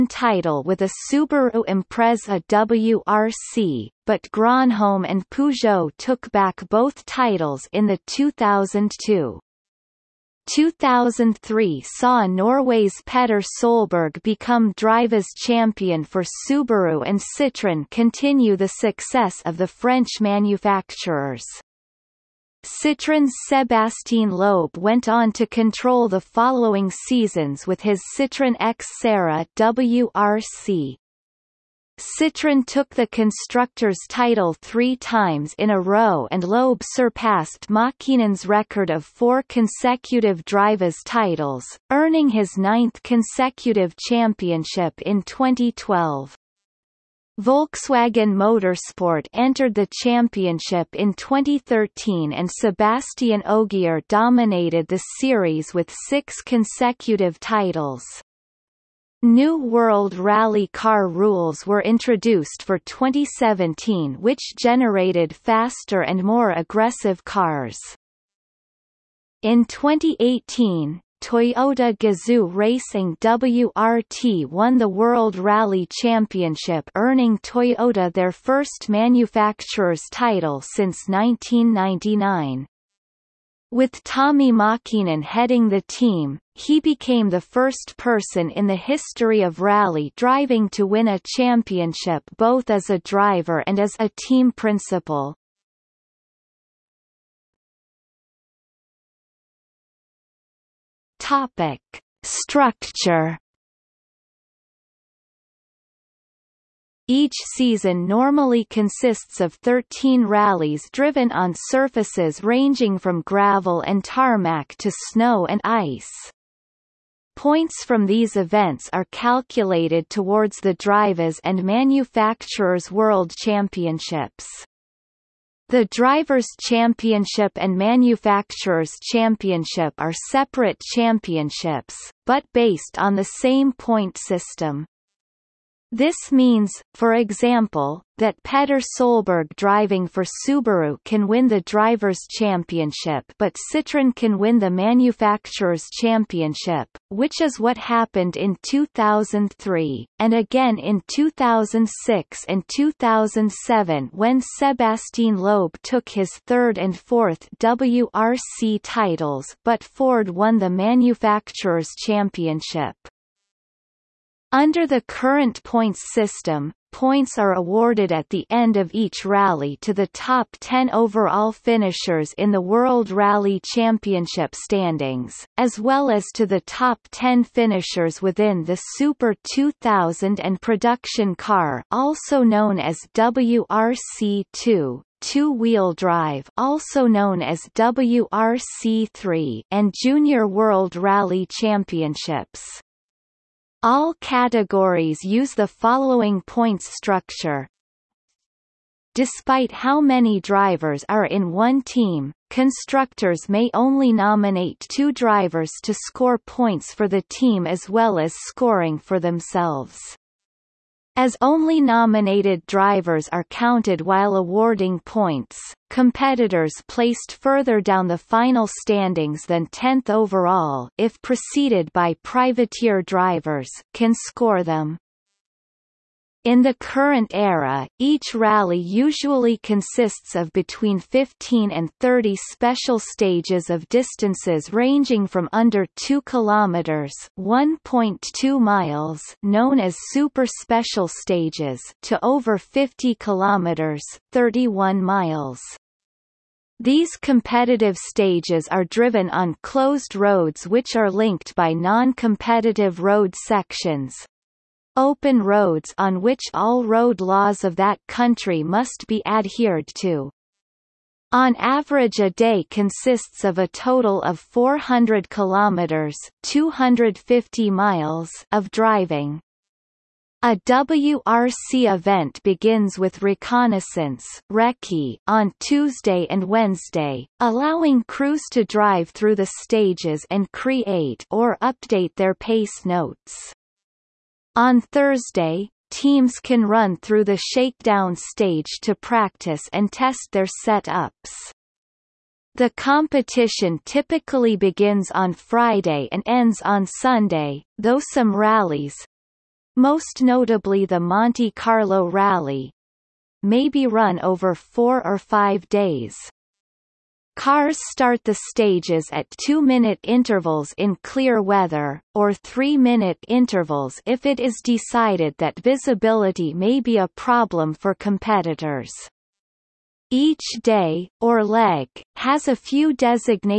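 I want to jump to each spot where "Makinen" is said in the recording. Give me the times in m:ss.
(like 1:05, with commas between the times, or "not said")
0:37, 1:24.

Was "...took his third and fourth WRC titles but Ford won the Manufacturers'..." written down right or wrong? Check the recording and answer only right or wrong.
right.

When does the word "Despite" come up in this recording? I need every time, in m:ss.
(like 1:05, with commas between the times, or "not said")
3:19.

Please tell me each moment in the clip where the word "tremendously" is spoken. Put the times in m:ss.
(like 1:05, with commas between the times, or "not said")
not said.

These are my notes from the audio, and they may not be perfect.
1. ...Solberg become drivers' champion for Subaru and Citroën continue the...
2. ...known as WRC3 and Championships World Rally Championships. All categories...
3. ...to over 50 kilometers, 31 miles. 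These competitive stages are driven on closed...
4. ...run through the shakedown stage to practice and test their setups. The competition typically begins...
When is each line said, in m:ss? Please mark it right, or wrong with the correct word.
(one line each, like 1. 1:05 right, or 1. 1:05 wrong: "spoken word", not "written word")
1. 0:13 right
2. 3:07 wrong: "Junior", not "Championships"
3. 4:02 right
4. 4:46 right.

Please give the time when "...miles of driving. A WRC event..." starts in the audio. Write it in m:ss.
4:27.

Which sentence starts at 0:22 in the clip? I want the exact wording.
Citroën's Sebastien Loeb went on to control the following seasons with his Citroën X Serra WRC.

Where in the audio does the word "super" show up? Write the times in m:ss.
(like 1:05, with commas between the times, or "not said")
2:58, 4:00.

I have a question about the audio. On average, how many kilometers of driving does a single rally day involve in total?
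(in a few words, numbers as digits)
400 kilometers.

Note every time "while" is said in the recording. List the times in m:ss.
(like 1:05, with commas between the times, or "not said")
3:34.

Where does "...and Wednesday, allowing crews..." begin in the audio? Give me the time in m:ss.
4:36.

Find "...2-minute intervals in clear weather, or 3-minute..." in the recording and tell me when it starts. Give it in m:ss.
5:09.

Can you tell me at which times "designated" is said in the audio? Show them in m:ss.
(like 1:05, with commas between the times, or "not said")
5:22.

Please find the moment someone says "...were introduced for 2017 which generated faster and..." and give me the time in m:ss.
1:01.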